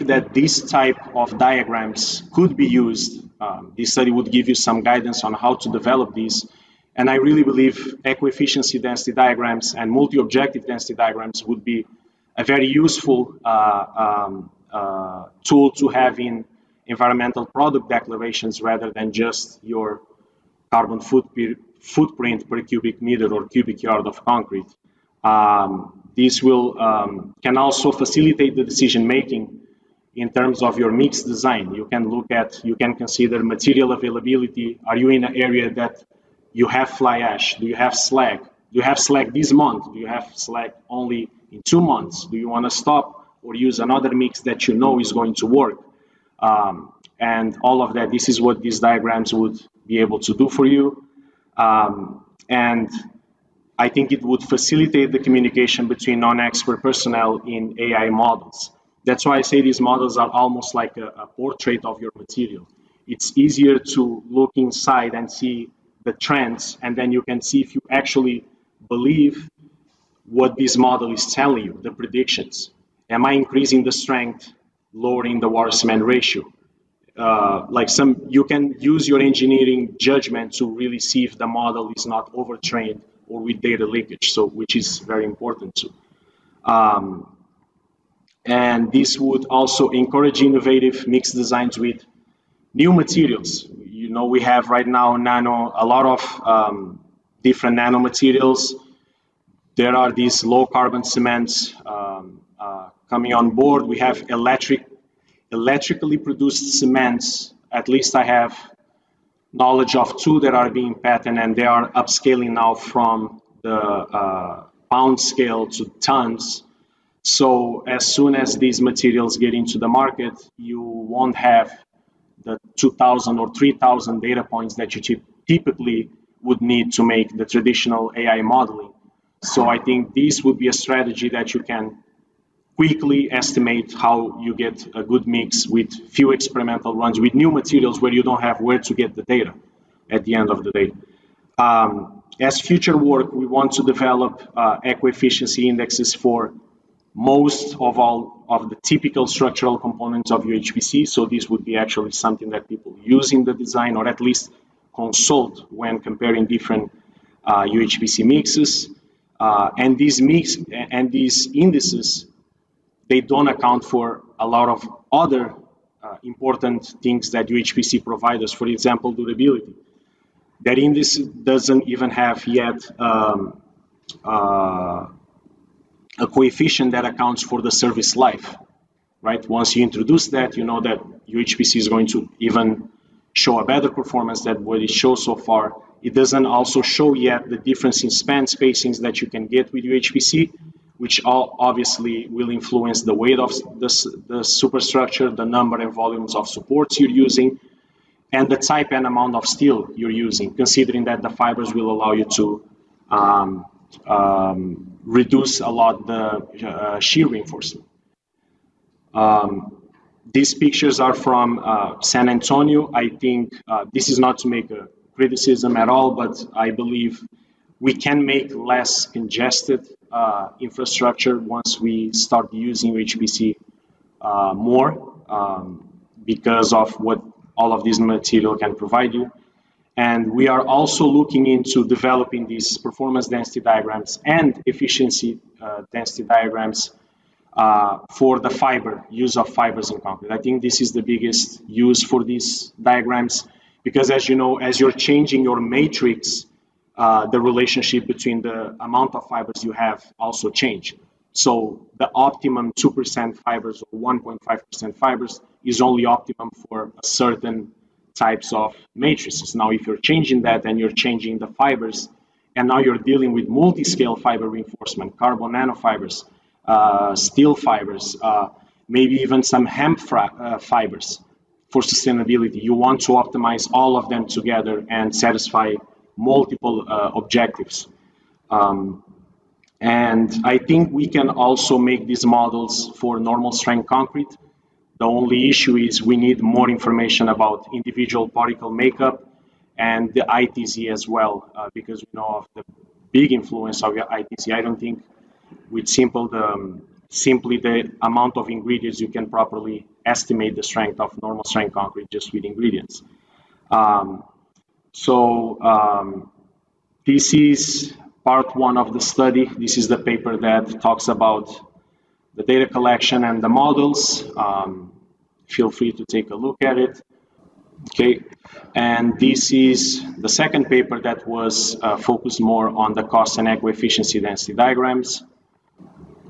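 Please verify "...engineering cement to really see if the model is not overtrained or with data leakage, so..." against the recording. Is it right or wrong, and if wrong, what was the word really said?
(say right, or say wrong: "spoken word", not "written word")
wrong: "judgment", not "cement".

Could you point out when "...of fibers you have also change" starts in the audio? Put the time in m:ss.
4:09.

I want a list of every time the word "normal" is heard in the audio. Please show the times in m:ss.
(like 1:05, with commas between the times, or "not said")
4:43, 5:01.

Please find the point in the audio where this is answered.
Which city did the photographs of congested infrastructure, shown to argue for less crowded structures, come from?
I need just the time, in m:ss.
3:32.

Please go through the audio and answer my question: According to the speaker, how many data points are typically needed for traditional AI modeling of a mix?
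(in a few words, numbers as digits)
2,000 or 3,000.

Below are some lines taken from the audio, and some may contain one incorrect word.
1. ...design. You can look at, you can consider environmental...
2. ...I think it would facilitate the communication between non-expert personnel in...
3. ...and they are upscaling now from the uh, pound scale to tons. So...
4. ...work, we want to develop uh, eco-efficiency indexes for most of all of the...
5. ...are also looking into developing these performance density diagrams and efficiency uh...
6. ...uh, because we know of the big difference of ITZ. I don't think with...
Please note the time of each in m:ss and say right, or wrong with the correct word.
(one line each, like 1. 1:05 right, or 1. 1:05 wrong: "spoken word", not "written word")
1. 0:31 wrong: "material", not "environmental"
2. 0:53 right
3. 1:51 right
4. 2:22 right
5. 3:50 right
6. 4:51 wrong: "influence", not "difference".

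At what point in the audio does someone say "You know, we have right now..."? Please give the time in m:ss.
1:33.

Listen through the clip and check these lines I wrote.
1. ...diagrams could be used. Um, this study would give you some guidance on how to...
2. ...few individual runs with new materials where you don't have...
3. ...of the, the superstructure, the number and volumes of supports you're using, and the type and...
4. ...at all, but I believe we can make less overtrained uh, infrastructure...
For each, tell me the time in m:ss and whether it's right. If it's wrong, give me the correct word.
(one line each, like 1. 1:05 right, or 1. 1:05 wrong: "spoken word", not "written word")
1. 0:01 right
2. 2:16 wrong: "experimental", not "individual"
3. 3:13 right
4. 3:35 wrong: "congested", not "overtrained".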